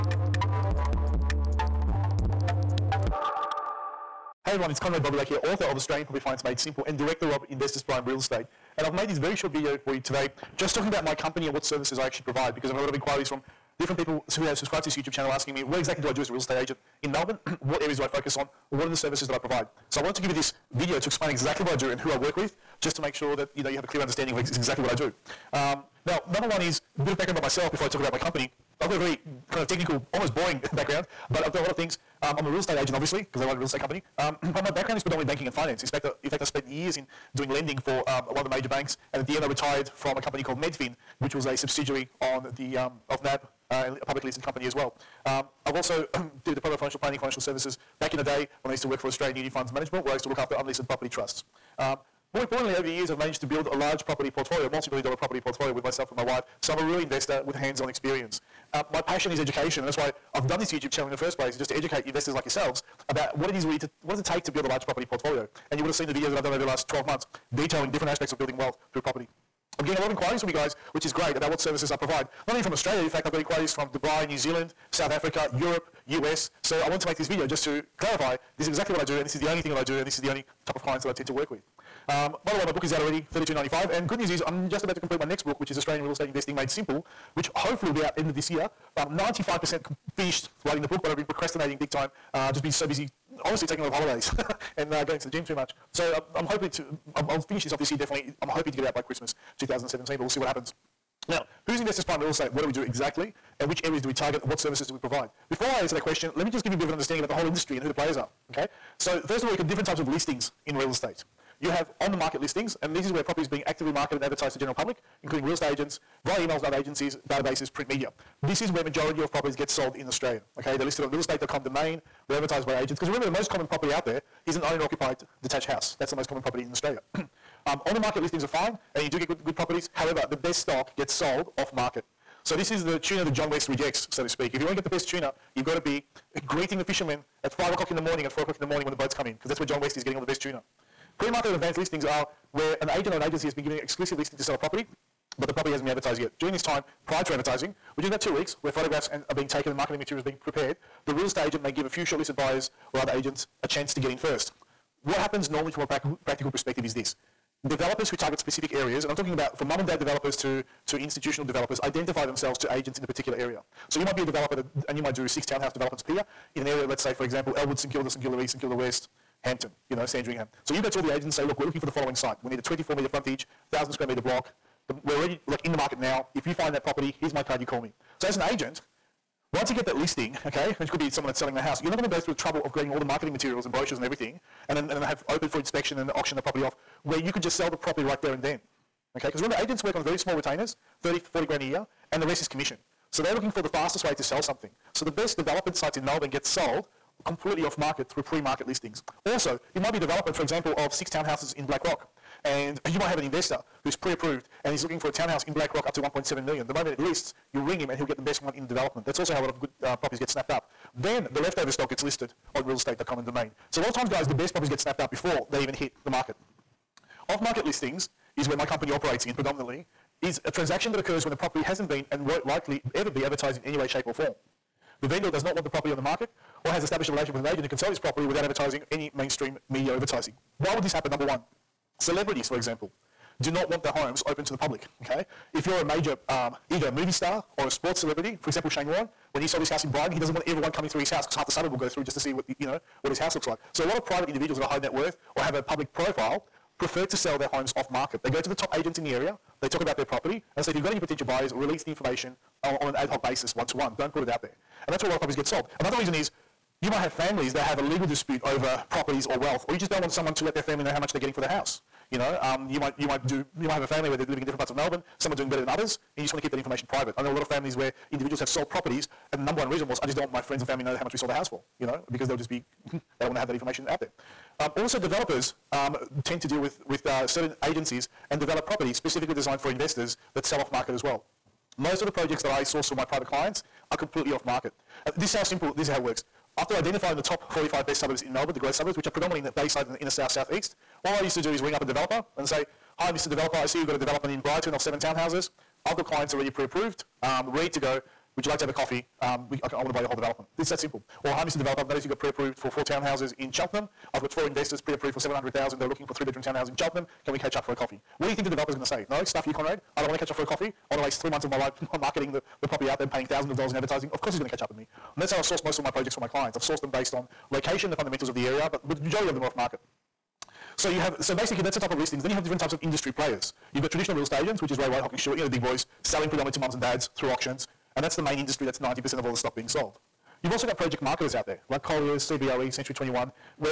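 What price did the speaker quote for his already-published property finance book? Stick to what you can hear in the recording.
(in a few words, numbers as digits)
32.95.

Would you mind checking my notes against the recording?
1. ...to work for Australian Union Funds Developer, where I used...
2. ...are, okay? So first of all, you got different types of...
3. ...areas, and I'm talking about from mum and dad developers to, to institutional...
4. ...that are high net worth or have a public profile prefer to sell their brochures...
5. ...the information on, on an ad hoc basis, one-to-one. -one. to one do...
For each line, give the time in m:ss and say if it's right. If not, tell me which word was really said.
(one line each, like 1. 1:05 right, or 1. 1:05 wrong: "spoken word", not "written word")
1. 0:48 wrong: "Management", not "Developer"
2. 1:48 right
3. 2:38 right
4. 4:04 wrong: "homes", not "brochures"
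5. 4:11 right.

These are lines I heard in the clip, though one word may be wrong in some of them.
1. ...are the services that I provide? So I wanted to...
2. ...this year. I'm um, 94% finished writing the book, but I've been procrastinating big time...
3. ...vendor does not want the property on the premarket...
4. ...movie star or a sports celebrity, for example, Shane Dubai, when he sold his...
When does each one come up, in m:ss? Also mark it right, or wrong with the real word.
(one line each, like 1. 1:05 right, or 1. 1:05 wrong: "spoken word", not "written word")
1. 0:18 right
2. 1:28 wrong: "95", not "94"
3. 3:45 wrong: "market", not "premarket"
4. 3:56 wrong: "Warne", not "Dubai".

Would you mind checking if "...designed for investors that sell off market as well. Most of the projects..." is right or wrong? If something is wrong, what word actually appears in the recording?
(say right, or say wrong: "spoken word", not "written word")
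right.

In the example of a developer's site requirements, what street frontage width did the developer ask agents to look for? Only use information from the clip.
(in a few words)
24 meters.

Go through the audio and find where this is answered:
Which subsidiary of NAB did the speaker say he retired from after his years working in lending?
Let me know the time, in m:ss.
0:40.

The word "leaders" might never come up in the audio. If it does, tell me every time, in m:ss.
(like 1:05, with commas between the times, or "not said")
not said.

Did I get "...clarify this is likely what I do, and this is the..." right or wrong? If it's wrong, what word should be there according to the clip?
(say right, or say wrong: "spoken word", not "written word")
wrong: "exactly", not "likely".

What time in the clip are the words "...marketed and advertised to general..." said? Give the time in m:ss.
1:53.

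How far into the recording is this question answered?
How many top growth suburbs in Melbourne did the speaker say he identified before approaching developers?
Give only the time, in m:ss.
4:47.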